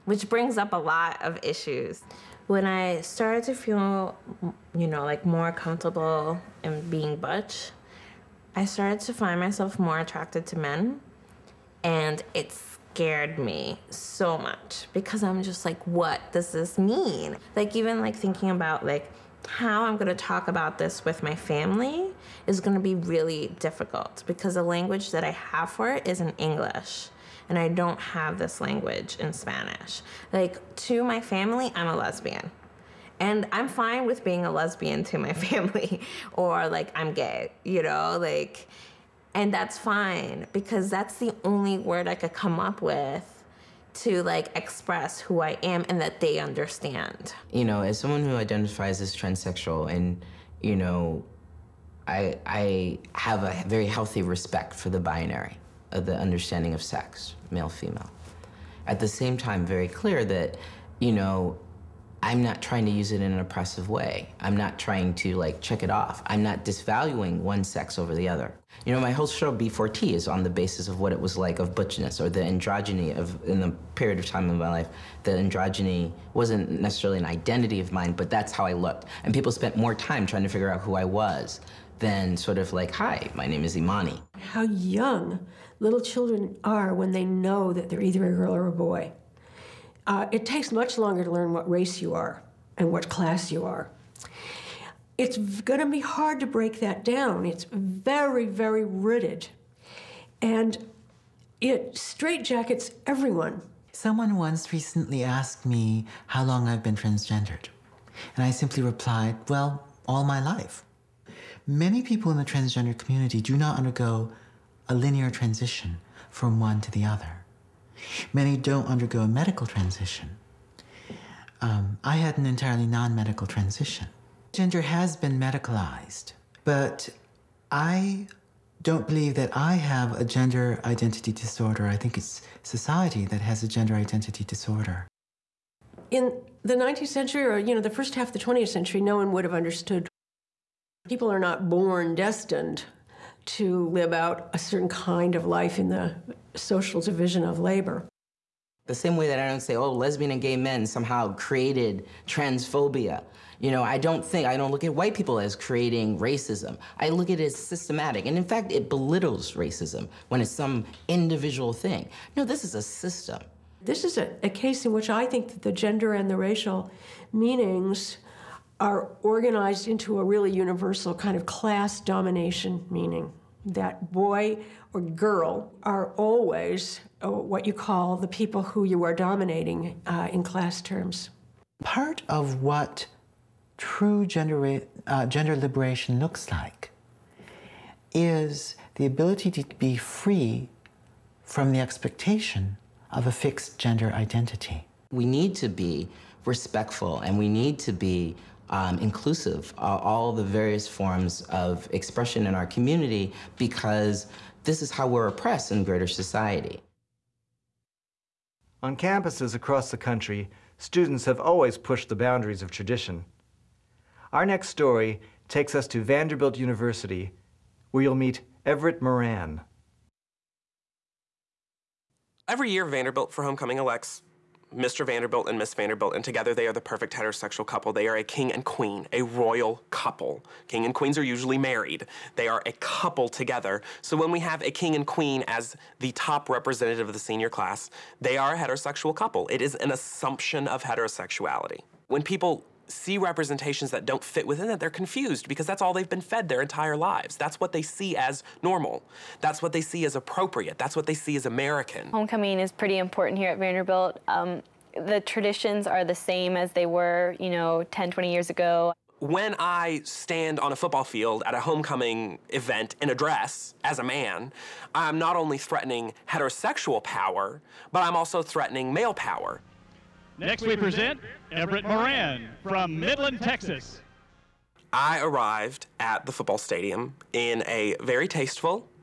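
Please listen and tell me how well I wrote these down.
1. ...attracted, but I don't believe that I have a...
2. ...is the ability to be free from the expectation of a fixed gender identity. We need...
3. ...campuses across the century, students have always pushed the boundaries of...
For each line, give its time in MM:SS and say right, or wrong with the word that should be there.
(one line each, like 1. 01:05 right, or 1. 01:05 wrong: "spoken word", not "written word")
1. 02:05 wrong: "medicalized", not "attracted"
2. 03:08 right
3. 03:28 wrong: "country", not "century".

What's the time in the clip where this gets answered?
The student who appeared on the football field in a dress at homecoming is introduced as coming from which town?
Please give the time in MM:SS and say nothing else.
04:32.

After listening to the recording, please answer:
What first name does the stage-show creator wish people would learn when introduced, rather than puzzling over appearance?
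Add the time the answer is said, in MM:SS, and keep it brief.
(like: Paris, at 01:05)
Imani, at 01:23.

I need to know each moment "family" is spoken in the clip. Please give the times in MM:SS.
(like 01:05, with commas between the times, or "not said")
00:21, 00:31, 00:35.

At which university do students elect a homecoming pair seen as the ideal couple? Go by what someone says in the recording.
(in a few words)
Vanderbilt University.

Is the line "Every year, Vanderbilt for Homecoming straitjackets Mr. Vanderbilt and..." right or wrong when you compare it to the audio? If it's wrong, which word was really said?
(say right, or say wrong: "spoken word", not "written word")
wrong: "elects", not "straitjackets".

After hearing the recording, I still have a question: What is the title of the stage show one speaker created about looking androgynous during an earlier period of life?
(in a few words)
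B4T.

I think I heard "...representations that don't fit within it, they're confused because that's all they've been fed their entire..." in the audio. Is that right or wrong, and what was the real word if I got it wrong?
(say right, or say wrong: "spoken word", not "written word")
right.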